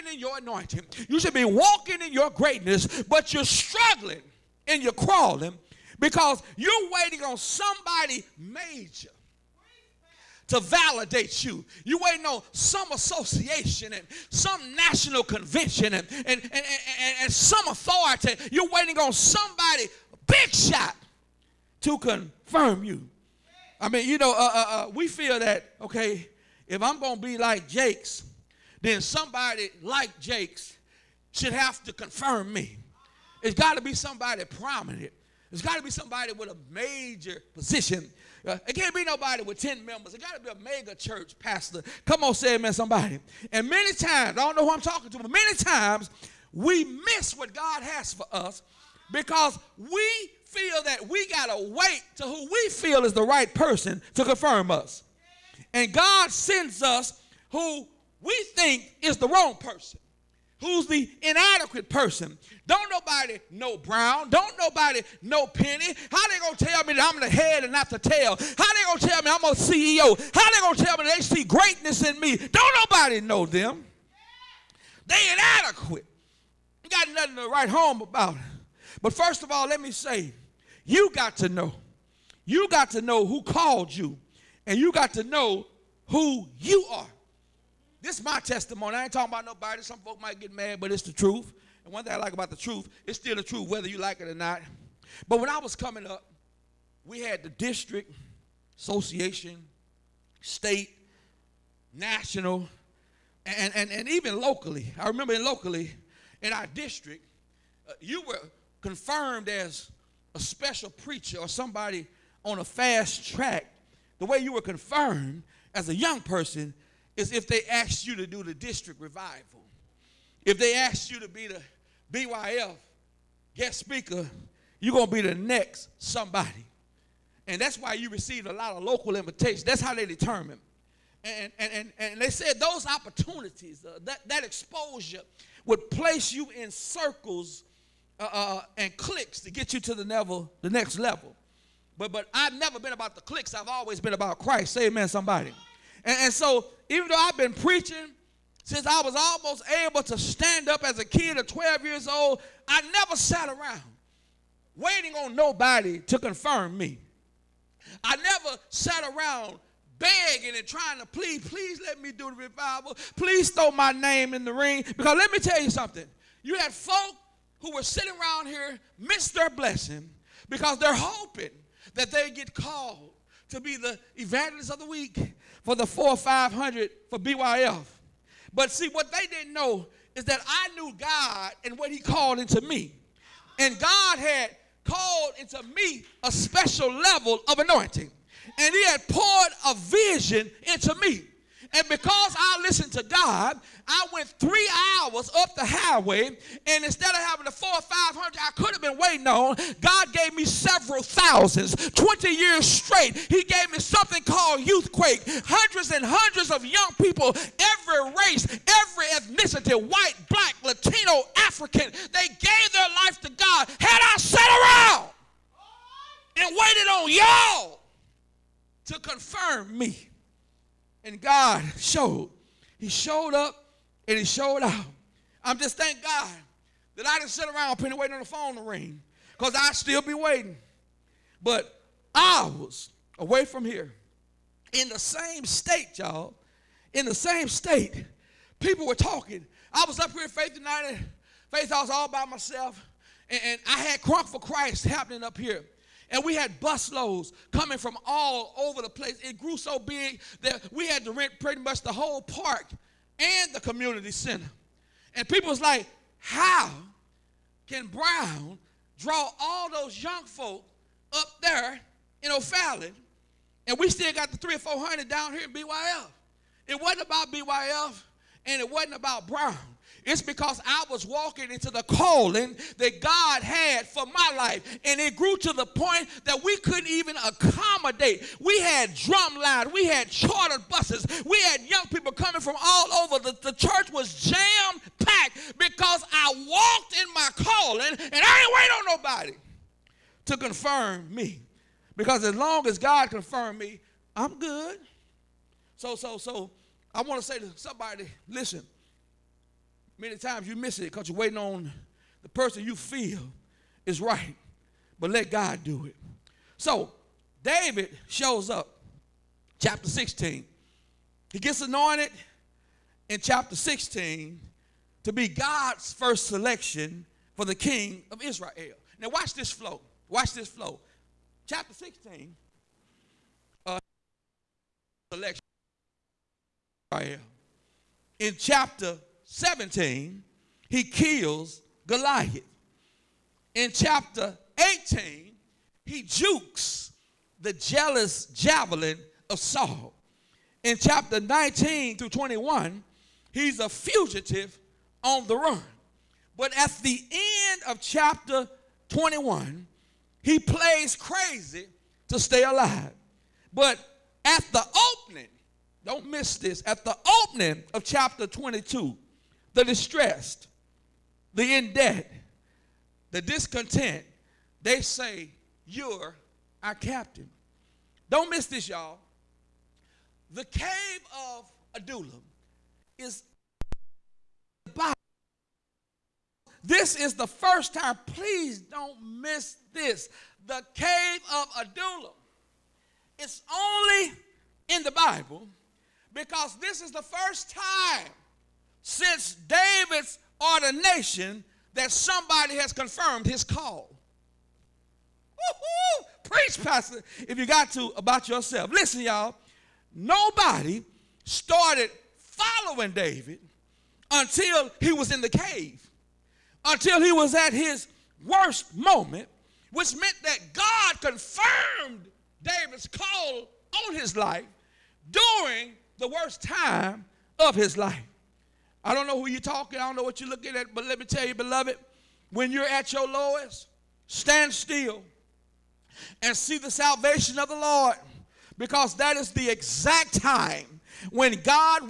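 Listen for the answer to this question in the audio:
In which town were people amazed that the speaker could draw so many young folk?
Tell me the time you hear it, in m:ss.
4:22.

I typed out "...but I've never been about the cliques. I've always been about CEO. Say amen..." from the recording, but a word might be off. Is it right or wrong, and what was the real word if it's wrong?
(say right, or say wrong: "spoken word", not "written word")
wrong: "Christ", not "CEO".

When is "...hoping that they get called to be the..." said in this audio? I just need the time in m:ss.
2:50.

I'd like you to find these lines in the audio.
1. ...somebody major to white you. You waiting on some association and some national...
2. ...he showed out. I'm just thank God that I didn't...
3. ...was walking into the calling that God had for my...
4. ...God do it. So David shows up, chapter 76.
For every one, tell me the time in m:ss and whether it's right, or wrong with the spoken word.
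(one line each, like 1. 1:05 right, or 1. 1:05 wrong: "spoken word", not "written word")
1. 0:07 wrong: "validate", not "white"
2. 3:44 right
3. 4:30 right
4. 5:05 wrong: "16", not "76".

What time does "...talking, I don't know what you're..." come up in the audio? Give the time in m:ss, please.
6:59.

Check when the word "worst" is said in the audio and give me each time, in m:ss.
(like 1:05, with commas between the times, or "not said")
6:48, 6:56.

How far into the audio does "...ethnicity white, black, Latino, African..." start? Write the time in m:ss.
3:29.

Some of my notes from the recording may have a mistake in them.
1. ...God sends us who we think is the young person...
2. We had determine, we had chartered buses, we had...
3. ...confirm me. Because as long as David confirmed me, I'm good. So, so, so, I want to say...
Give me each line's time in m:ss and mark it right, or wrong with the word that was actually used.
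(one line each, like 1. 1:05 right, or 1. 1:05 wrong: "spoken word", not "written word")
1. 0:55 wrong: "wrong", not "young"
2. 4:38 wrong: "drumline", not "determine"
3. 4:50 wrong: "God", not "David".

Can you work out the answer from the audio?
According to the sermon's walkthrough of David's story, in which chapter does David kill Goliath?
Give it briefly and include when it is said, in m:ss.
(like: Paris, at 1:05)
Chapter 17, at 5:28.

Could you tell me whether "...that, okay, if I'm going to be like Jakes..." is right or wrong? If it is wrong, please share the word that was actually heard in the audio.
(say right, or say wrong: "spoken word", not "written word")
right.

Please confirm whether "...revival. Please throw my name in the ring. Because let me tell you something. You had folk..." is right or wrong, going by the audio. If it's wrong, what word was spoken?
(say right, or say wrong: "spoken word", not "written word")
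right.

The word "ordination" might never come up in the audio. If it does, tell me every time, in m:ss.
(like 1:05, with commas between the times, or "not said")
6:30.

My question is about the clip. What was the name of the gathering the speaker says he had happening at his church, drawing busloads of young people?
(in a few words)
Crunk for Christ.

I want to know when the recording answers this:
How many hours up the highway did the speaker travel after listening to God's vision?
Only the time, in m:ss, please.
3:14.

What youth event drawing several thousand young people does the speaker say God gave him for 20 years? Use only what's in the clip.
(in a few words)
Youthquake.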